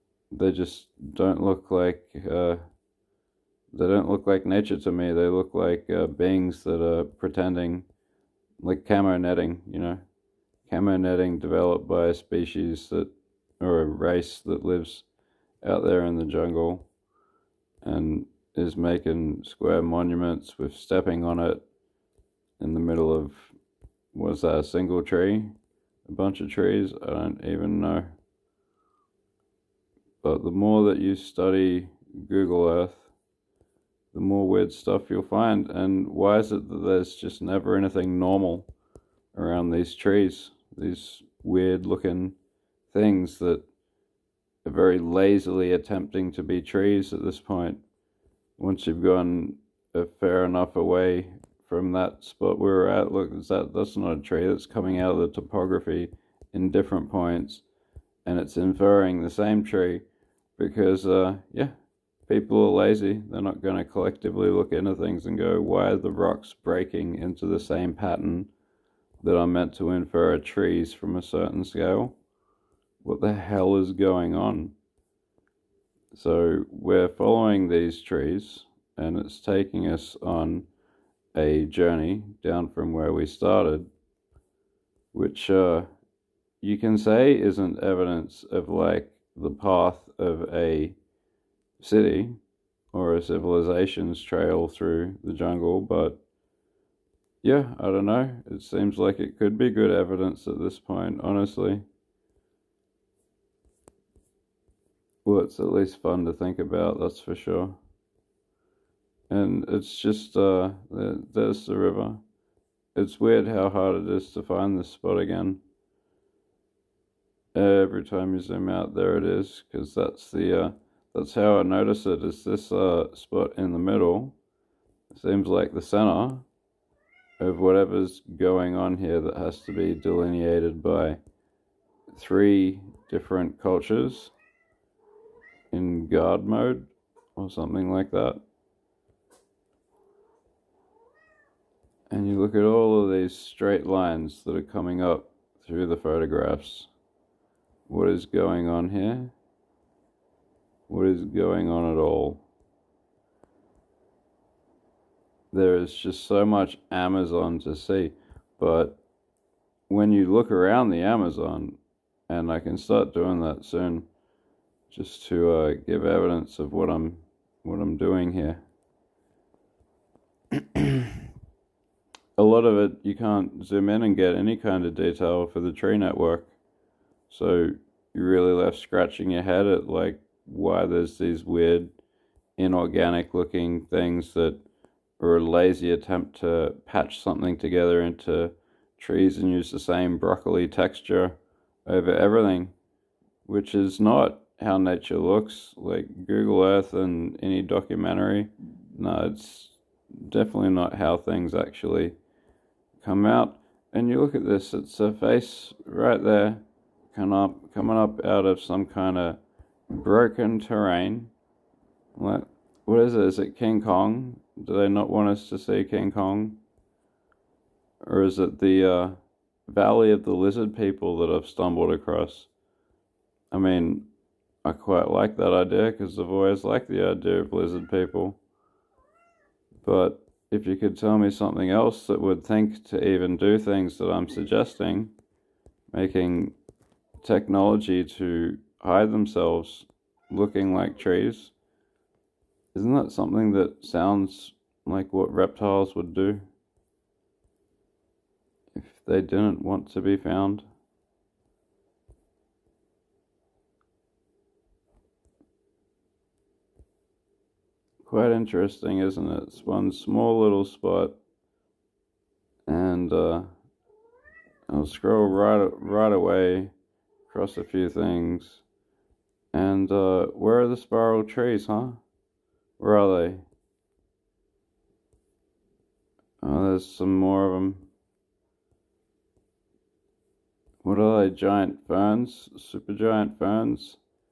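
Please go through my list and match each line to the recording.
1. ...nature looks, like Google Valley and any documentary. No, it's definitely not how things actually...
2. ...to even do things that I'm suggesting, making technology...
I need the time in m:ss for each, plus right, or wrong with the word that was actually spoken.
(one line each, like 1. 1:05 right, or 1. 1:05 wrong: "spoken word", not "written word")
1. 3:14 wrong: "Earth", not "Valley"
2. 3:52 right.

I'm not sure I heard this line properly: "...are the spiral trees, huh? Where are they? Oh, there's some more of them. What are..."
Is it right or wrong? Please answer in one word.
right.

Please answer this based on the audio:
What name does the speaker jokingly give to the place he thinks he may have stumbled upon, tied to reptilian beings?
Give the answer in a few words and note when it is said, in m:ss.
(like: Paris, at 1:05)
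Valley of the Lizard People, at 3:39.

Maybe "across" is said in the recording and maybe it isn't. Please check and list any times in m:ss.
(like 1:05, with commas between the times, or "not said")
3:41, 4:27.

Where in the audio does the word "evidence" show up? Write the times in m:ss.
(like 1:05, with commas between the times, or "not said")
1:27, 1:39, 2:46.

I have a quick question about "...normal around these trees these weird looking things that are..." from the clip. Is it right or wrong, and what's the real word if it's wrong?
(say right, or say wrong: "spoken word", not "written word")
right.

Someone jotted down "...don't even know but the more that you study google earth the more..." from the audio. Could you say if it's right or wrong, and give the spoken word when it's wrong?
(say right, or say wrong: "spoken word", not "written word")
right.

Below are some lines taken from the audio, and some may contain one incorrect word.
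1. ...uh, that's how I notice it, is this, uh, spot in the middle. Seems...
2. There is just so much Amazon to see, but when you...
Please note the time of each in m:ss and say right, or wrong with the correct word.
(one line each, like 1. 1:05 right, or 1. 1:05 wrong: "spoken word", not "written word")
1. 2:00 right
2. 2:35 right.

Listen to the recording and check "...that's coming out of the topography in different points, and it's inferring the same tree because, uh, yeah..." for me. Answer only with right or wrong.
right.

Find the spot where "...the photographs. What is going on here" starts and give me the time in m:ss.
2:25.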